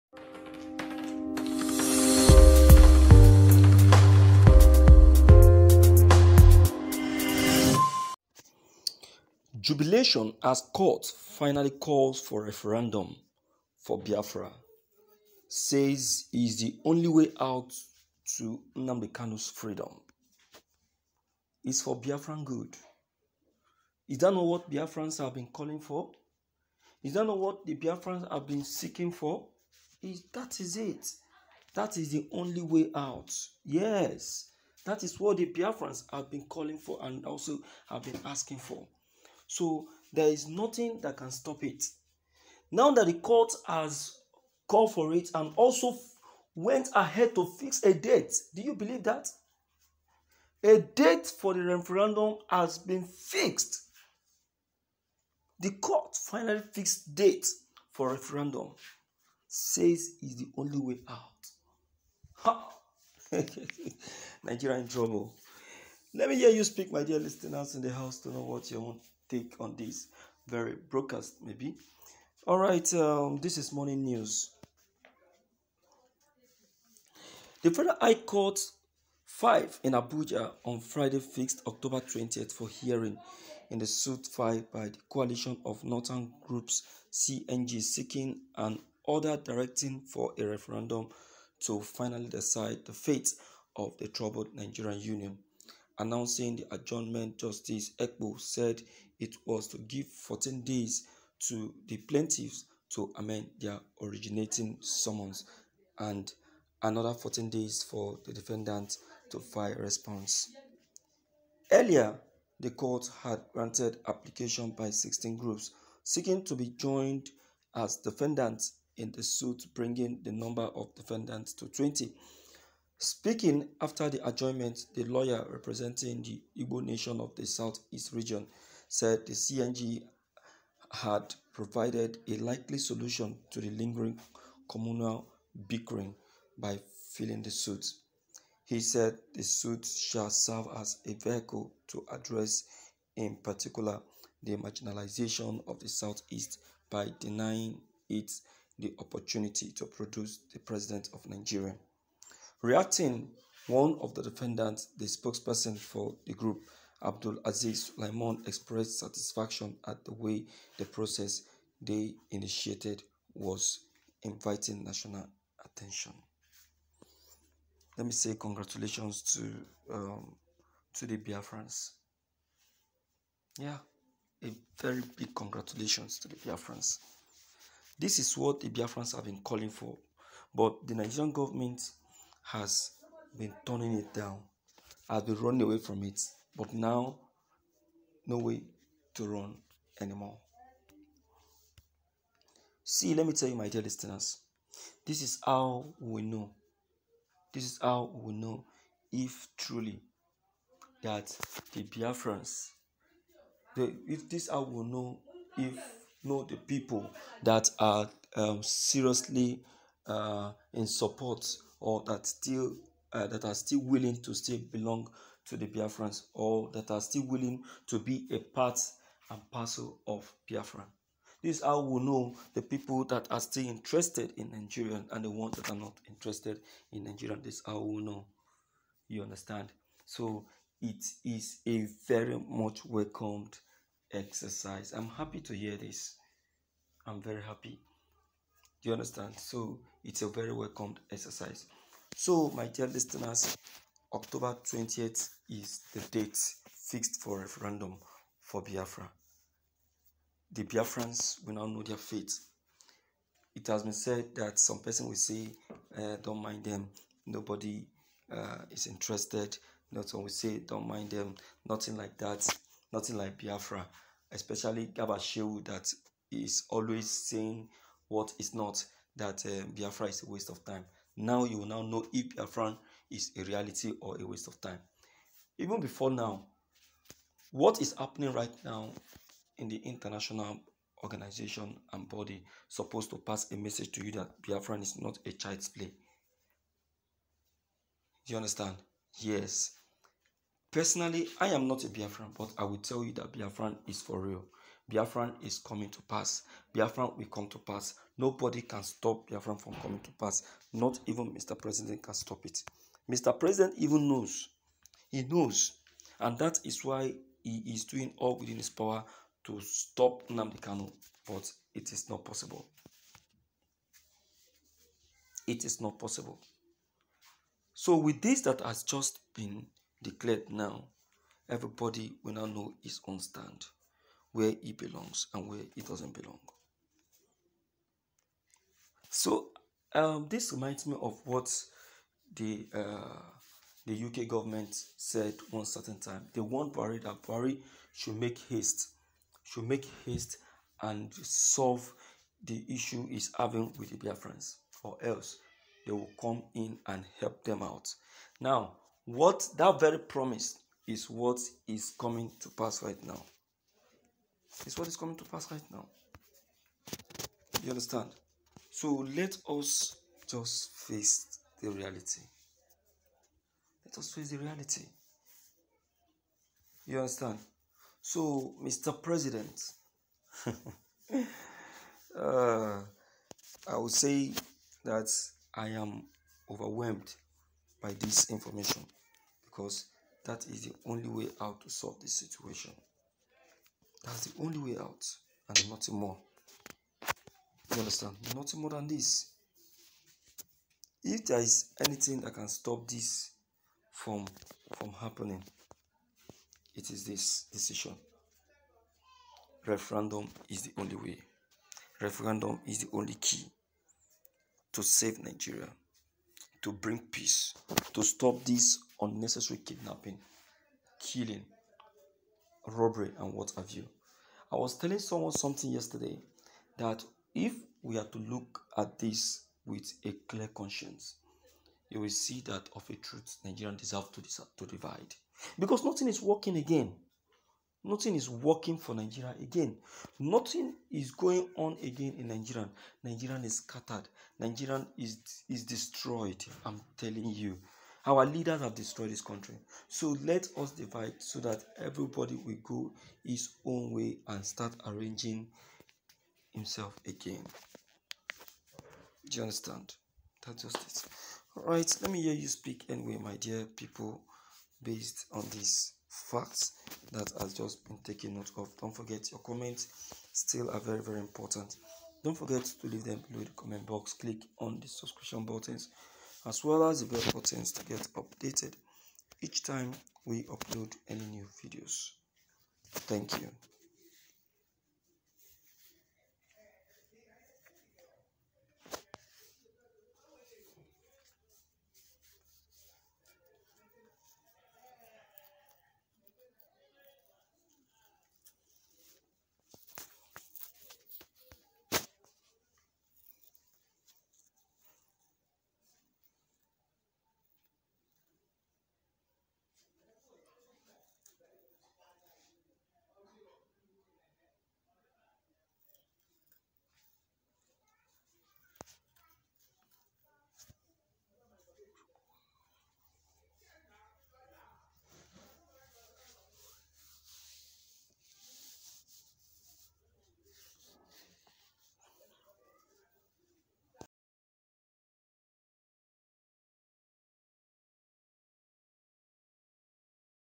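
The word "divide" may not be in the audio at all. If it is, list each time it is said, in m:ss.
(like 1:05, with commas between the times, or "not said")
7:04, 7:20.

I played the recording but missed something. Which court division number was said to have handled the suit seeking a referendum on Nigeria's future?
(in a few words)
Federal High Court 5.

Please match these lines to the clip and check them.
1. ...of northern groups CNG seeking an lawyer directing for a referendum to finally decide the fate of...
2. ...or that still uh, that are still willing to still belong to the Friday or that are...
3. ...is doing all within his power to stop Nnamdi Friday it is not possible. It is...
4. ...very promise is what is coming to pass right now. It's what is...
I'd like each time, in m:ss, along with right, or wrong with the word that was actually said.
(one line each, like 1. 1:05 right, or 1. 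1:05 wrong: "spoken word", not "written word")
1. 1:25 wrong: "order", not "lawyer"
2. 3:31 wrong: "Biafrans", not "Friday"
3. 5:07 wrong: "But", not "Friday"
4. 5:49 right.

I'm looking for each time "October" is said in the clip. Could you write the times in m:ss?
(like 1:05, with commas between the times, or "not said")
1:21, 4:04.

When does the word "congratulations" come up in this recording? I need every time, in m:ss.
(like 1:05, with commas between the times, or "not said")
2:48, 2:55.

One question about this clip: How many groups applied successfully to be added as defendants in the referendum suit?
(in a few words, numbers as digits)
16.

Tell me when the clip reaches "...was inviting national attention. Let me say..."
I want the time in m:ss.
2:43.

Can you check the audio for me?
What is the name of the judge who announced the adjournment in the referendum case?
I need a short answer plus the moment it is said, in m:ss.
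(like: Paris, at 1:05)
Justice Ekwo, at 1:37.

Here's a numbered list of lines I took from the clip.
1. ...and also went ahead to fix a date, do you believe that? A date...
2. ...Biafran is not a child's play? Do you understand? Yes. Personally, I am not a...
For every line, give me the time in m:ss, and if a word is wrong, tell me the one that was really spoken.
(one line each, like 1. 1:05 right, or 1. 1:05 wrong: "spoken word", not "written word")
1. 0:45 right
2. 4:44 right.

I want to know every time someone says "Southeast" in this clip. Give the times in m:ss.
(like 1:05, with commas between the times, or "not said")
2:07, 2:25.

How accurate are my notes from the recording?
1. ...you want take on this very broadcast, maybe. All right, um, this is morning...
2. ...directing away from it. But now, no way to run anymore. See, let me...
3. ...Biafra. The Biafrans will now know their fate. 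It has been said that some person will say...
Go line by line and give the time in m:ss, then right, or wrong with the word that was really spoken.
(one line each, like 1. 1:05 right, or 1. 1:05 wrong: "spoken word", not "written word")
1. 1:08 right
2. 3:05 wrong: "running", not "directing"
3. 4:08 right.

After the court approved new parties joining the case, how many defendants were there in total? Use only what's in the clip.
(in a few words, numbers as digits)
20.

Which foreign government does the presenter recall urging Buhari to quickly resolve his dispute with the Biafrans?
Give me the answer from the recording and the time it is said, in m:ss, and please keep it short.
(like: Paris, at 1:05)
UK, at 5:34.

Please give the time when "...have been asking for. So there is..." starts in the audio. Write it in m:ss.
0:37.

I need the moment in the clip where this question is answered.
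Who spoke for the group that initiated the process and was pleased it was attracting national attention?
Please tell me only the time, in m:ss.
2:37.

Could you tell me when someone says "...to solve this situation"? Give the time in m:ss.
6:21.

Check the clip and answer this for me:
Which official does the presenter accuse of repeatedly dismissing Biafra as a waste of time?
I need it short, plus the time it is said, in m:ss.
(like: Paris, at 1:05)
Garba Shehu, at 4:24.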